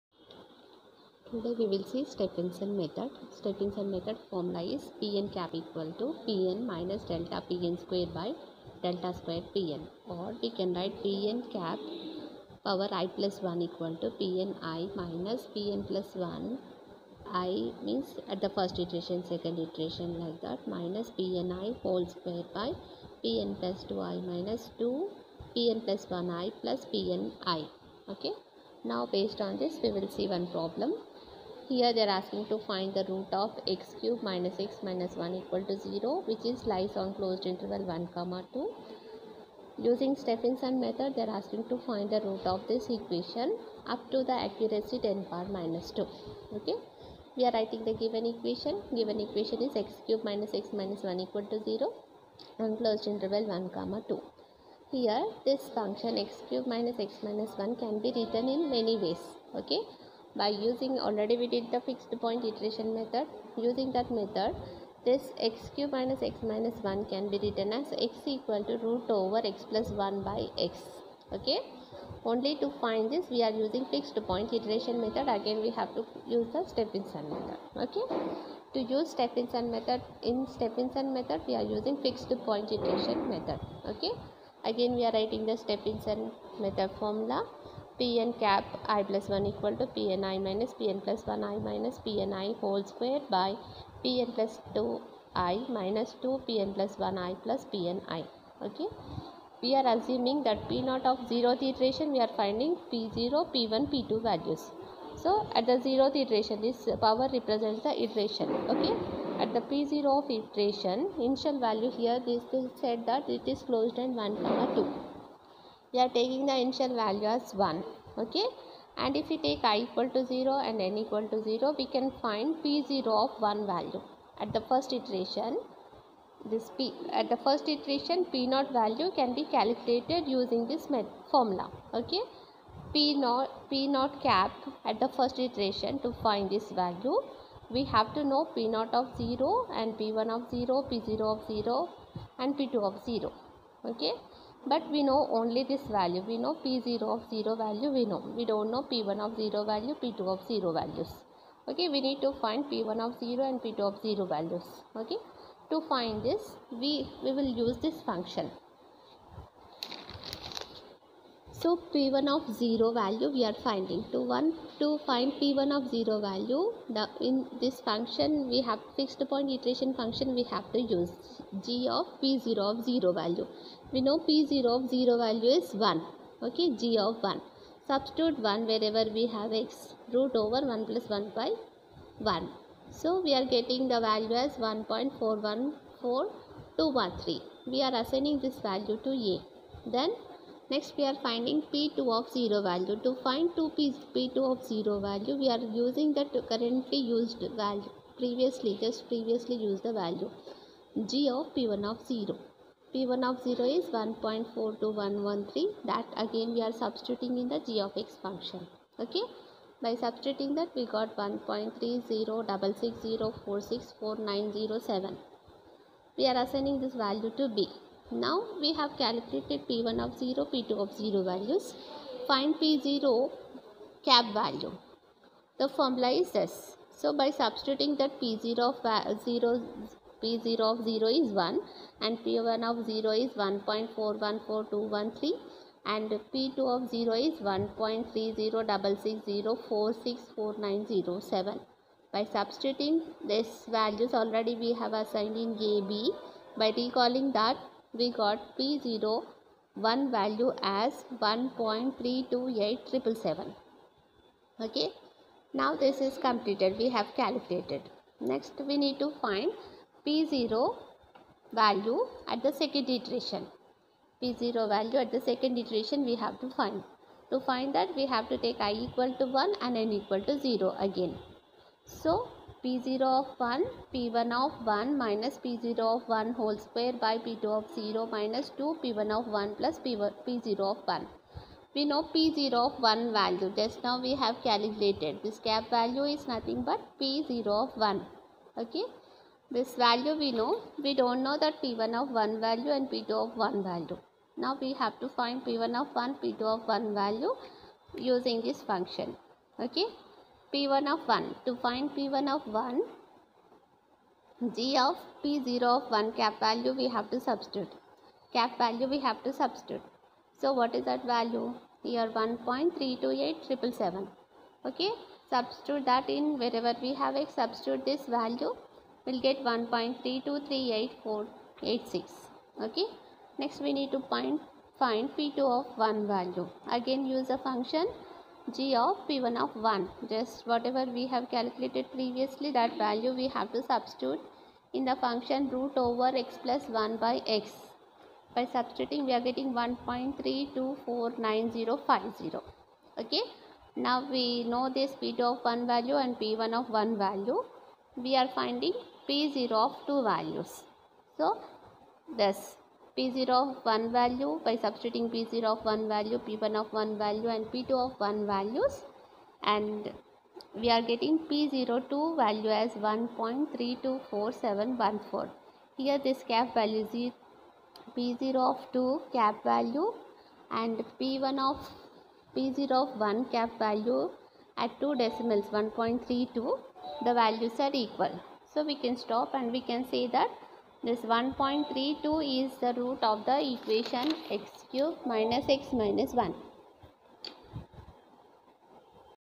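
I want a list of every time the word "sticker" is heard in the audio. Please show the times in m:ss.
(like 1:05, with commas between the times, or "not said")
not said.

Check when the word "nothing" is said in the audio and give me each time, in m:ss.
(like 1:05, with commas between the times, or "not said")
4:46.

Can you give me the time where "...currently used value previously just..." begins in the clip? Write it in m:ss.
3:16.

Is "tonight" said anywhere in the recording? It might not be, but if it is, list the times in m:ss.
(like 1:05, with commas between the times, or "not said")
not said.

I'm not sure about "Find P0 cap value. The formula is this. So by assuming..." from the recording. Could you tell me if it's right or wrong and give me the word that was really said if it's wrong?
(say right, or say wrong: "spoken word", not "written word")
wrong: "substituting", not "assuming".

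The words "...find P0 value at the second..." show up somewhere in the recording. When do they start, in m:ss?
4:19.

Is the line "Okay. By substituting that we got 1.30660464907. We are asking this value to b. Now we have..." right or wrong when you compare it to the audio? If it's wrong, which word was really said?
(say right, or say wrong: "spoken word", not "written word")
wrong: "assigning", not "asking".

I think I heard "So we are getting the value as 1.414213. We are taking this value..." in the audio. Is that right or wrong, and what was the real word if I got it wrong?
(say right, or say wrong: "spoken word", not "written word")
wrong: "assigning", not "taking".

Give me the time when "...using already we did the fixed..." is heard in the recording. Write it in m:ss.
1:00.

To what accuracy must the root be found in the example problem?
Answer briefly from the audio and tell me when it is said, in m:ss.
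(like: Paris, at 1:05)
10^-2, at 0:44.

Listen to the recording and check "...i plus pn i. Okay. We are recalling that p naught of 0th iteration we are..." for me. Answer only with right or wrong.
wrong.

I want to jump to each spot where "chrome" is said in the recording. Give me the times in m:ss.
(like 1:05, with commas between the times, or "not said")
not said.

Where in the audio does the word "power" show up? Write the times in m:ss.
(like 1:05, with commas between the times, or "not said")
0:12, 0:45, 1:47.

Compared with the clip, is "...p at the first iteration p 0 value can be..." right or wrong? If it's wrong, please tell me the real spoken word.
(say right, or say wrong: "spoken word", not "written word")
right.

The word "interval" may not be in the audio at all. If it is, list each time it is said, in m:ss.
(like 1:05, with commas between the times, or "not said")
0:37, 0:53.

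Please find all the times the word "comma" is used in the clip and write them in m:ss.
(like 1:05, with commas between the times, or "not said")
0:38, 0:53, 1:54.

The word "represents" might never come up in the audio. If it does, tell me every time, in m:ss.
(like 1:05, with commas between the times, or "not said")
1:47.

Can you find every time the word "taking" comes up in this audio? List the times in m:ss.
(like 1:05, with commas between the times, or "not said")
1:56.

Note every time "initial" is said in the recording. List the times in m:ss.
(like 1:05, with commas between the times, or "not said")
1:51, 1:56.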